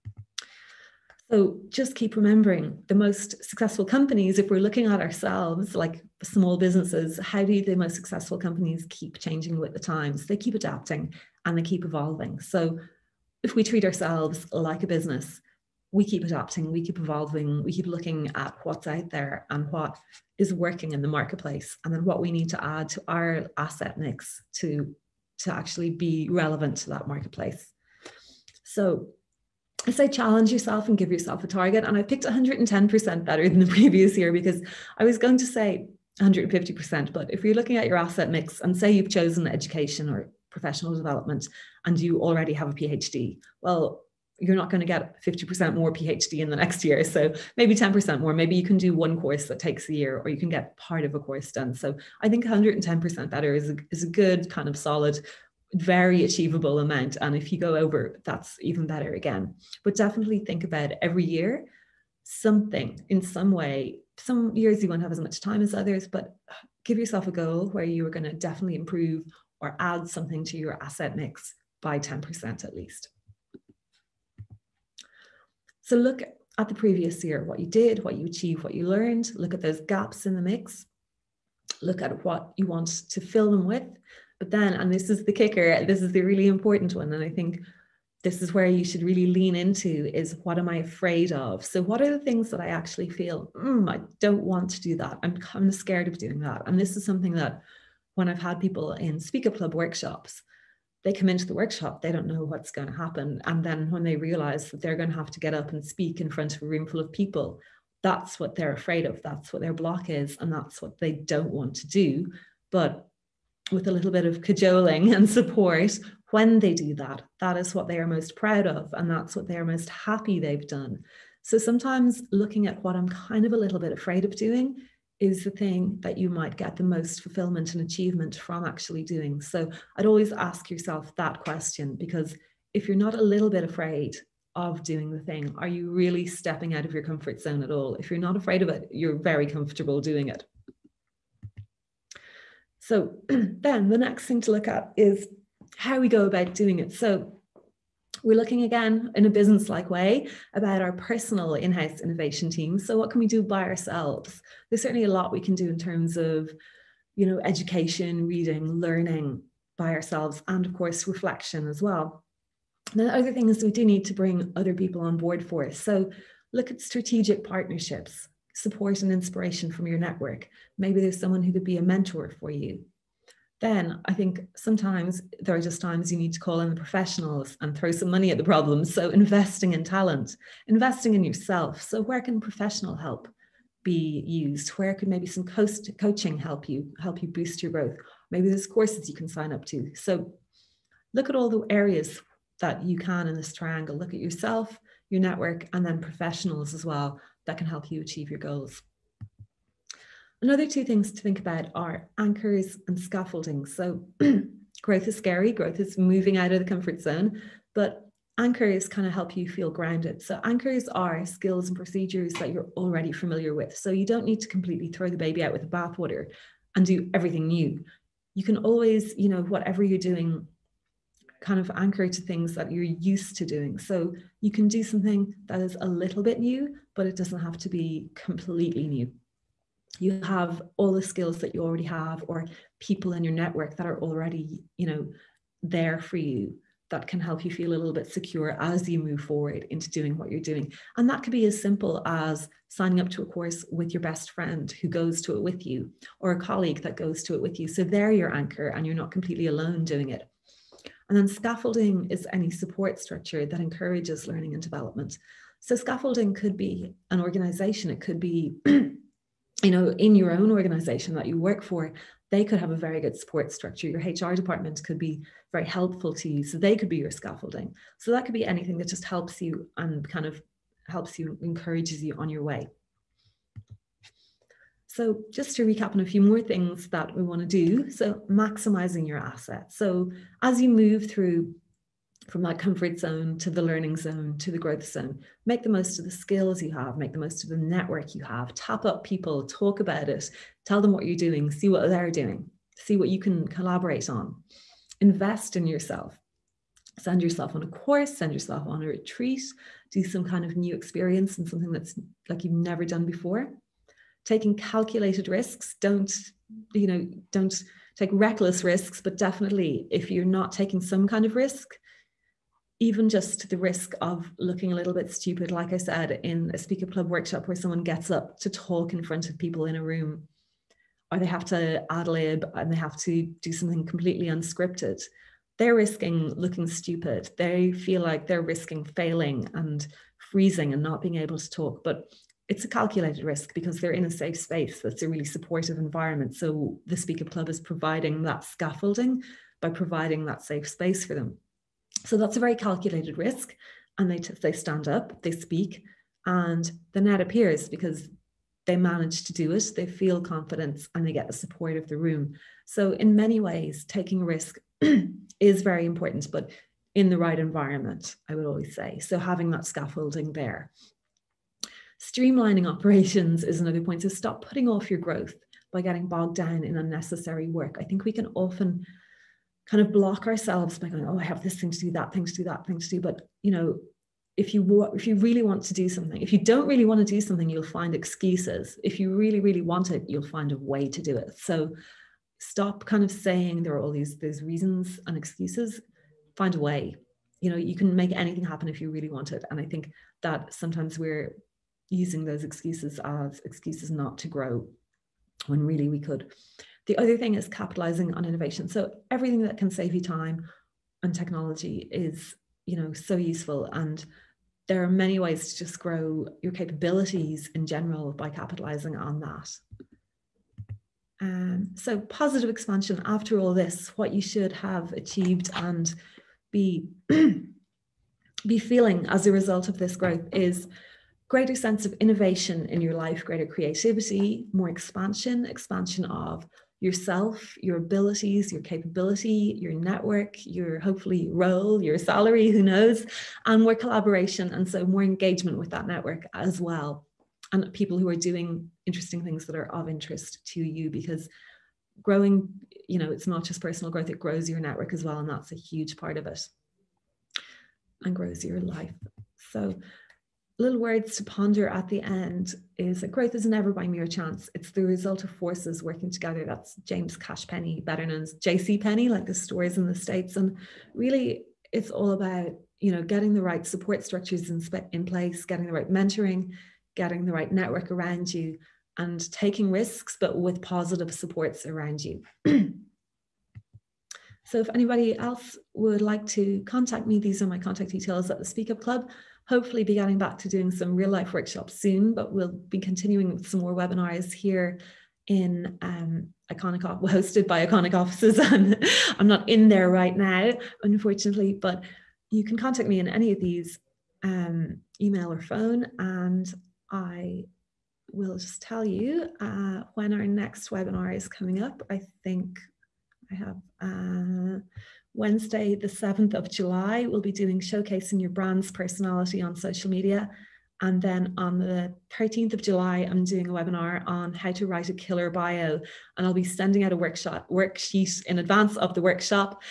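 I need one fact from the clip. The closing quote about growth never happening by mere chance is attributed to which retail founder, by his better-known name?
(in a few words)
J.C. Penny.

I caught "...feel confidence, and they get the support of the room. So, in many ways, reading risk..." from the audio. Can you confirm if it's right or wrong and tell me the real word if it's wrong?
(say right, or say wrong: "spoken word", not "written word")
wrong: "taking", not "reading".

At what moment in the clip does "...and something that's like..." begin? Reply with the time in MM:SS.
05:01.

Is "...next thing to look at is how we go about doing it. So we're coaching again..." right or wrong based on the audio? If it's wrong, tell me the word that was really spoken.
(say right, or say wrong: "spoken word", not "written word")
wrong: "looking", not "coaching".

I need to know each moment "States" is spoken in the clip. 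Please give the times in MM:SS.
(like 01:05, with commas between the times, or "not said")
07:39.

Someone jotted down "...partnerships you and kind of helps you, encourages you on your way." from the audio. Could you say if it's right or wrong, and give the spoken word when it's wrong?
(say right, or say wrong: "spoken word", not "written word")
wrong: "helps", not "partnerships".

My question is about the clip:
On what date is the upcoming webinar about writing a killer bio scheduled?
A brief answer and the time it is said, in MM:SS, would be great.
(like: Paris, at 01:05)
13th of July, at 08:32.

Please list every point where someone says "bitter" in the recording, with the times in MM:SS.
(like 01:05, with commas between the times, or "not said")
not said.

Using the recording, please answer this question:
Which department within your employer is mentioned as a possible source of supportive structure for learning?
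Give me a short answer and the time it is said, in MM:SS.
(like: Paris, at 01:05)
HR department, at 04:24.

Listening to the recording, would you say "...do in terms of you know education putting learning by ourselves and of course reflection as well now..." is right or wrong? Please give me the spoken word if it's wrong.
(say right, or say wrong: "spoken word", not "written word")
wrong: "reading", not "putting".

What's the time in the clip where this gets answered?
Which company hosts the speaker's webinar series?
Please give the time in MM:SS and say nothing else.
08:07.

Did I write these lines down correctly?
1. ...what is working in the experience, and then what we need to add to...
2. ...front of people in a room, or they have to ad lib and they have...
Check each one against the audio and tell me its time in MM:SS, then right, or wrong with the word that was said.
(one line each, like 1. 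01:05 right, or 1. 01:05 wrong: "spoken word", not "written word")
1. 00:19 wrong: "marketplace", not "experience"
2. 05:19 right.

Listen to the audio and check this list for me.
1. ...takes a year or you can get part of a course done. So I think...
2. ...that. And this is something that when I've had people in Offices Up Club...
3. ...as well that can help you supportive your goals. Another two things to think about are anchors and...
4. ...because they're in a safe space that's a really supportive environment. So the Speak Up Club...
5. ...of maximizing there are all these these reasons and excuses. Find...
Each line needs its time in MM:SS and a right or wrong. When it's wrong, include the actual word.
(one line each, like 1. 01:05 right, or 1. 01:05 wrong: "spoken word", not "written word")
1. 00:49 right
2. 01:36 wrong: "Speak", not "Offices"
3. 03:16 wrong: "achieve", not "supportive"
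4. 05:33 right
5. 06:23 wrong: "saying", not "maximizing".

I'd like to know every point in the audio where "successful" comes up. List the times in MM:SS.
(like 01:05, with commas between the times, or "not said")
00:03, 00:07.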